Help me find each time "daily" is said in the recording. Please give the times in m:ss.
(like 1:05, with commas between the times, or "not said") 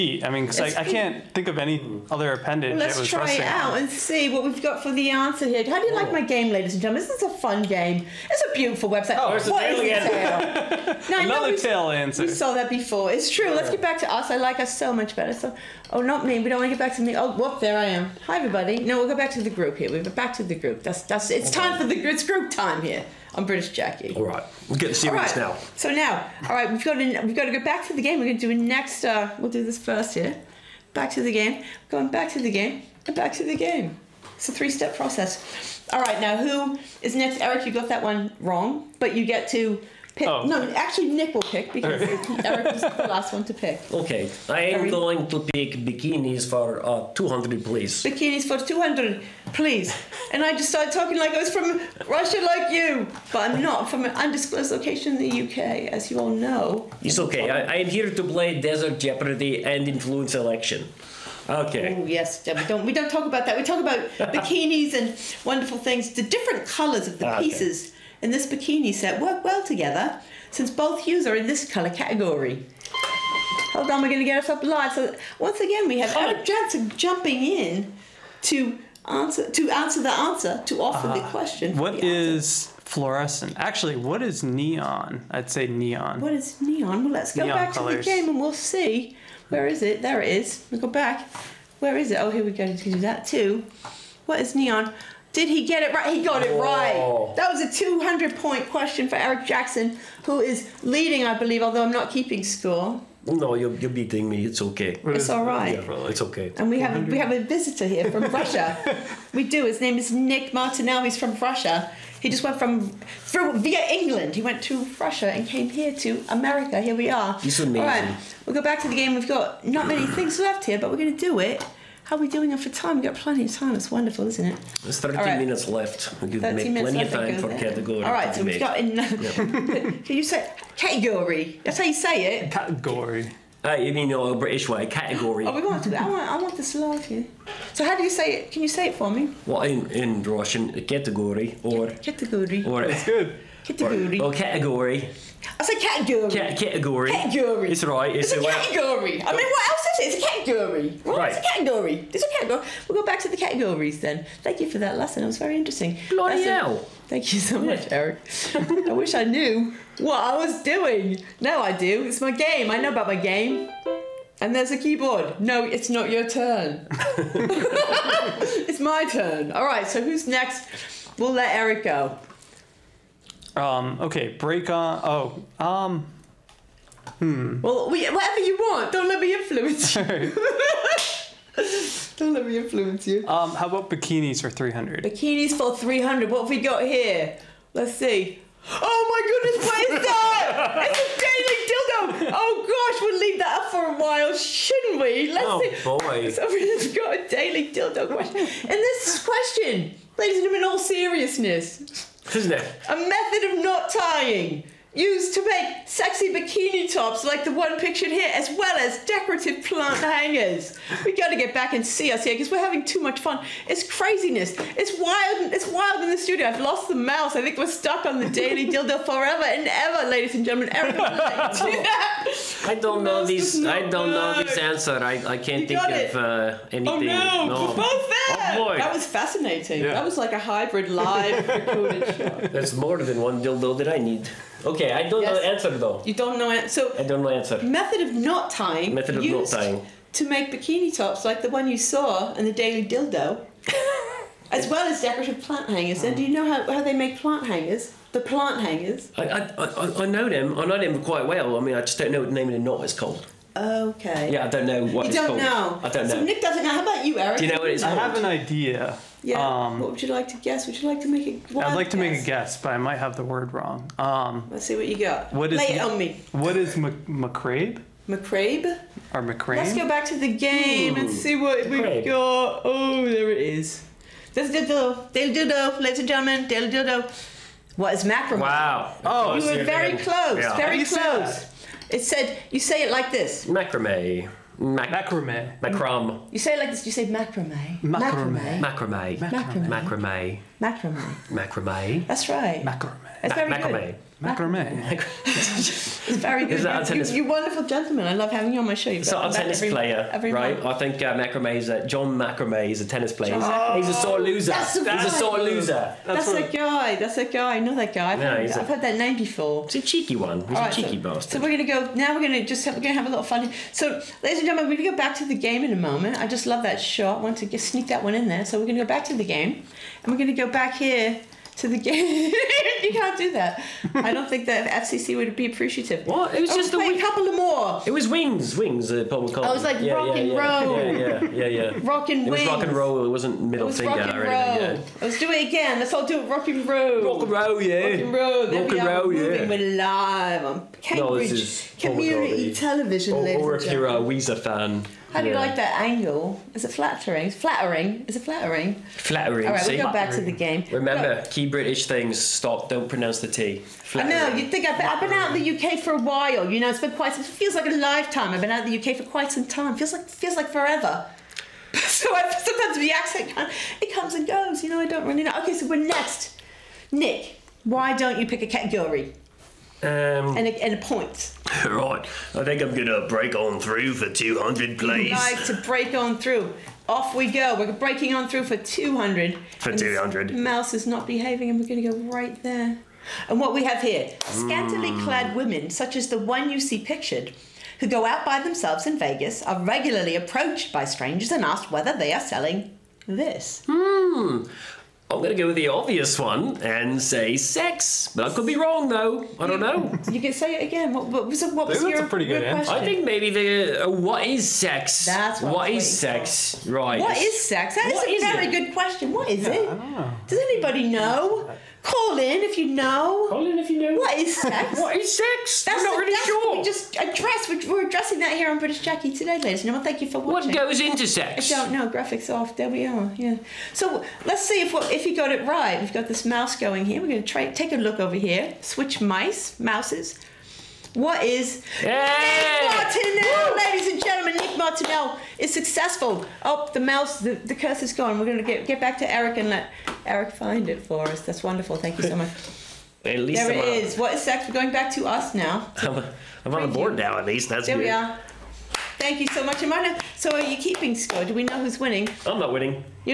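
3:11, 3:17, 3:38, 4:02.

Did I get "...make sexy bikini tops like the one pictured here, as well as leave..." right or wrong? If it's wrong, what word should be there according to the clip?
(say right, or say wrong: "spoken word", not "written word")
wrong: "decorative", not "leave".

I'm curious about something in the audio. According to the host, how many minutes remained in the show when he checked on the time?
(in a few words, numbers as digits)
13.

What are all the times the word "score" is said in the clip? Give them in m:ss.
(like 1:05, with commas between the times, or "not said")
1:42, 7:30.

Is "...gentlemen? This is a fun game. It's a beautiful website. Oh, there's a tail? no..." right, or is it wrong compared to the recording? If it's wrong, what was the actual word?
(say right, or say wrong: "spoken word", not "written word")
right.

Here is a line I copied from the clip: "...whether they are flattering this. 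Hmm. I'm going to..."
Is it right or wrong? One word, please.
wrong.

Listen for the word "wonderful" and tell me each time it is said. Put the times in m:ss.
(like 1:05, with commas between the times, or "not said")
1:05, 2:03, 4:57, 7:21.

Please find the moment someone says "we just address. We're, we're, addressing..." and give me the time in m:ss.
6:56.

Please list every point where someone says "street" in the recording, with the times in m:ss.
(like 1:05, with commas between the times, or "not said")
not said.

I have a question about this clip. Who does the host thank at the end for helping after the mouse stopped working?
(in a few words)
Amanda.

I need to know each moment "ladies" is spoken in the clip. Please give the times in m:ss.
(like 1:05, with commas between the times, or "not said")
0:06, 3:20, 3:40, 4:35, 5:14, 6:59, 7:11.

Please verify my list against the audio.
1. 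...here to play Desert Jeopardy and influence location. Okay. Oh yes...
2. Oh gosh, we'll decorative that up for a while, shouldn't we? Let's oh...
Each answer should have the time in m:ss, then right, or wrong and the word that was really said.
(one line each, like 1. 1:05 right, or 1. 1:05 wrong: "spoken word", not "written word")
1. 0:57 wrong: "election", not "location"
2. 3:12 wrong: "leave", not "decorative".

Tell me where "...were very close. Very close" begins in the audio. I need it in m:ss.
4:39.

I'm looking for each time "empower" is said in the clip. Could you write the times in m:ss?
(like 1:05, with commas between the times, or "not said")
not said.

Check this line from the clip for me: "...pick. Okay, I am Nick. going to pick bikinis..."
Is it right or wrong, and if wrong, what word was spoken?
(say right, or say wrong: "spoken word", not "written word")
wrong: "Erik", not "Nick".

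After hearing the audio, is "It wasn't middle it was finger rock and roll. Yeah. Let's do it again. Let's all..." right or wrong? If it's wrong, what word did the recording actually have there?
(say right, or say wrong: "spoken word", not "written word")
right.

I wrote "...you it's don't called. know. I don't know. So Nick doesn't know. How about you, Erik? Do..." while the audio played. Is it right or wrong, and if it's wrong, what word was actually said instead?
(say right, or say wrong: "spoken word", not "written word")
right.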